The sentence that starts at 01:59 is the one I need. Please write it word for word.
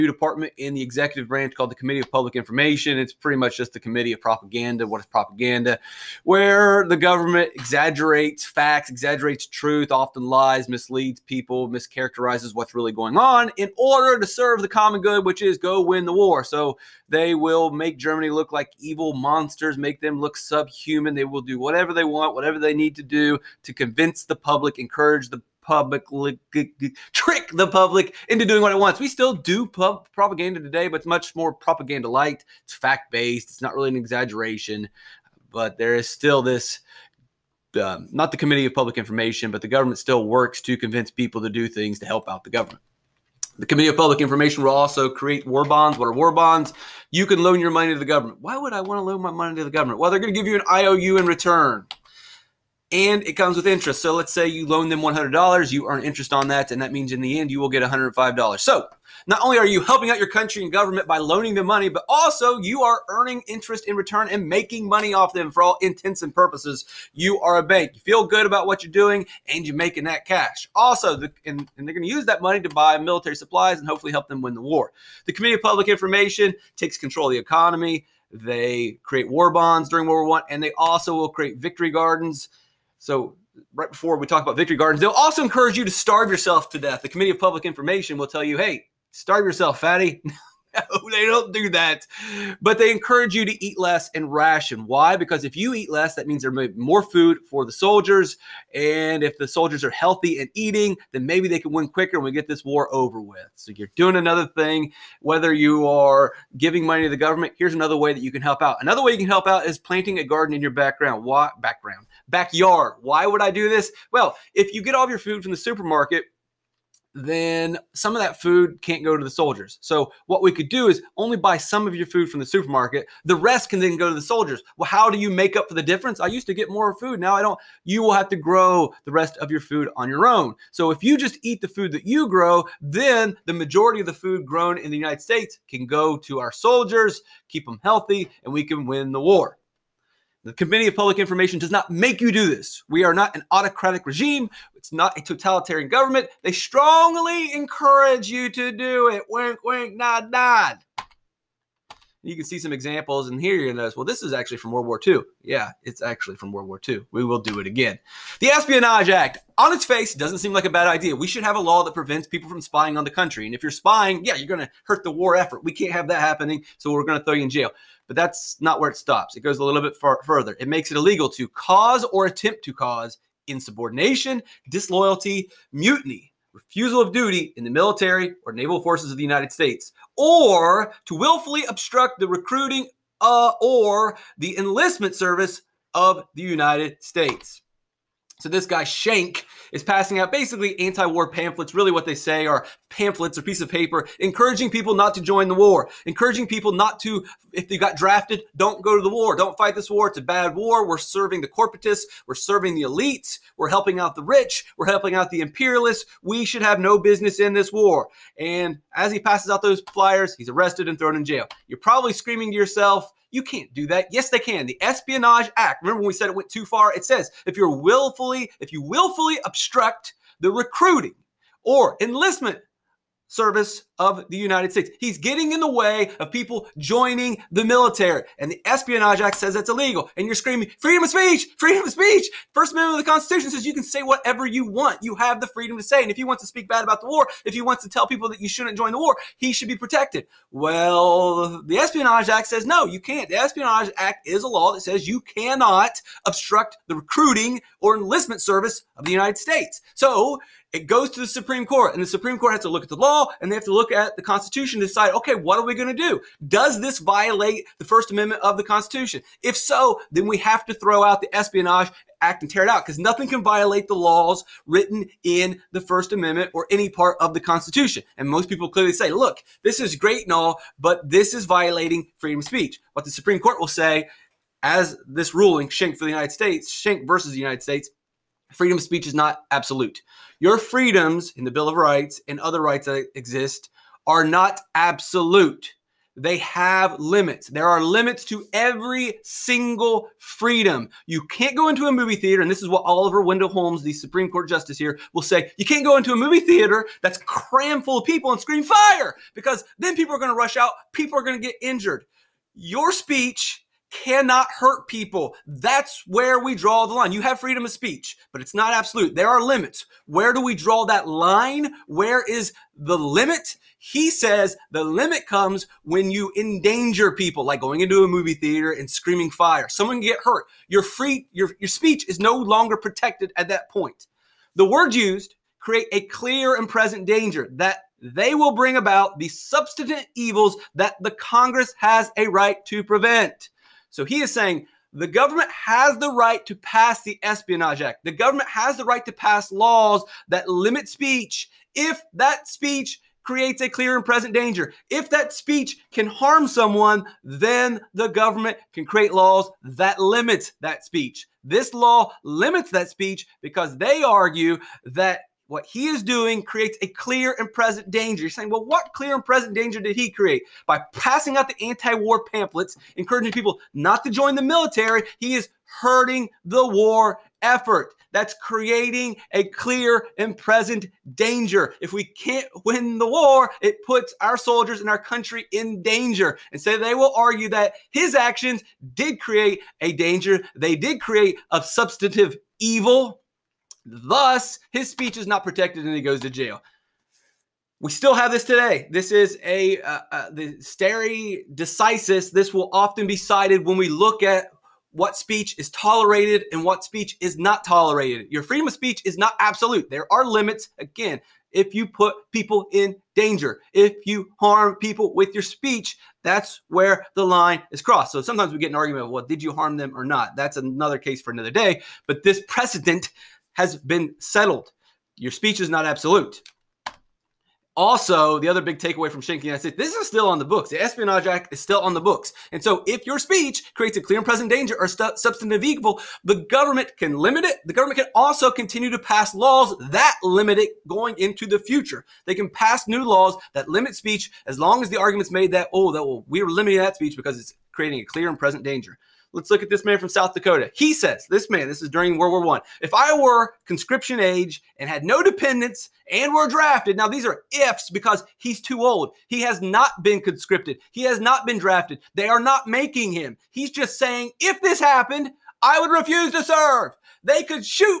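So what we could do is only buy some of your food from the supermarket.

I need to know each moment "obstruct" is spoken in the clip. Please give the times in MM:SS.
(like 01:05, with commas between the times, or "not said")
03:01, 03:39, 04:06.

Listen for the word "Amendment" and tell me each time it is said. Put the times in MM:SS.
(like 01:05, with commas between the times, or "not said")
03:52, 04:18, 04:26.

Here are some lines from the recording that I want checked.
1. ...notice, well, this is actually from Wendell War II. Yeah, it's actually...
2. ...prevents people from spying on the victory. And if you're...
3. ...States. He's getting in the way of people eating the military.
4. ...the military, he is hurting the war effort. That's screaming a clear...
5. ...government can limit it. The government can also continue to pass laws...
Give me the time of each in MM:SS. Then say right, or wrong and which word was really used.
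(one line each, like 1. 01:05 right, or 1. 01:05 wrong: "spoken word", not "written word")
1. 02:33 wrong: "World", not "Wendell"
2. 02:41 wrong: "country", not "victory"
3. 03:44 wrong: "joining", not "eating"
4. 06:04 wrong: "creating", not "screaming"
5. 07:06 right.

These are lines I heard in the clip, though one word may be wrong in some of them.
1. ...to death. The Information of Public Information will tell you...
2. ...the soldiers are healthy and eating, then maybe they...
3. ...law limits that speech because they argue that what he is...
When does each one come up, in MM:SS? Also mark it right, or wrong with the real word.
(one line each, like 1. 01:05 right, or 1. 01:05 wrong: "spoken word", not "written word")
1. 01:26 wrong: "Committee", not "Information"
2. 01:39 right
3. 05:51 right.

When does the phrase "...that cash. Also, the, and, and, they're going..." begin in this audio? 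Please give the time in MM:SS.
01:10.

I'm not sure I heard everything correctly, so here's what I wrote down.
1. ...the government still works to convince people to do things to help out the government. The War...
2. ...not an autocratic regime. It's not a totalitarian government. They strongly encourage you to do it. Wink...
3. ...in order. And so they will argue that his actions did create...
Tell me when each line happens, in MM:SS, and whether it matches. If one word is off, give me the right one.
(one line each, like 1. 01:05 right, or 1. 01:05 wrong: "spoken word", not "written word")
1. 00:39 wrong: "Committee", not "War"
2. 02:23 right
3. 06:15 wrong: "danger", not "order".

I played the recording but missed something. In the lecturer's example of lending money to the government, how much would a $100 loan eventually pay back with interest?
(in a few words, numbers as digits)
$105.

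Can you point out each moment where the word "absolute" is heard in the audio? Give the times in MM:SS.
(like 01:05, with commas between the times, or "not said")
04:39, 04:44, 05:08, 06:39, 06:55.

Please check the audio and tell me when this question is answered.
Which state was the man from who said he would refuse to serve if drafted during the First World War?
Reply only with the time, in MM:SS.
07:20.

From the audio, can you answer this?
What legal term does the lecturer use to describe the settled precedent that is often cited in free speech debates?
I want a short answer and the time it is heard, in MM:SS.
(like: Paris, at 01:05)
stare decisis, at 06:30.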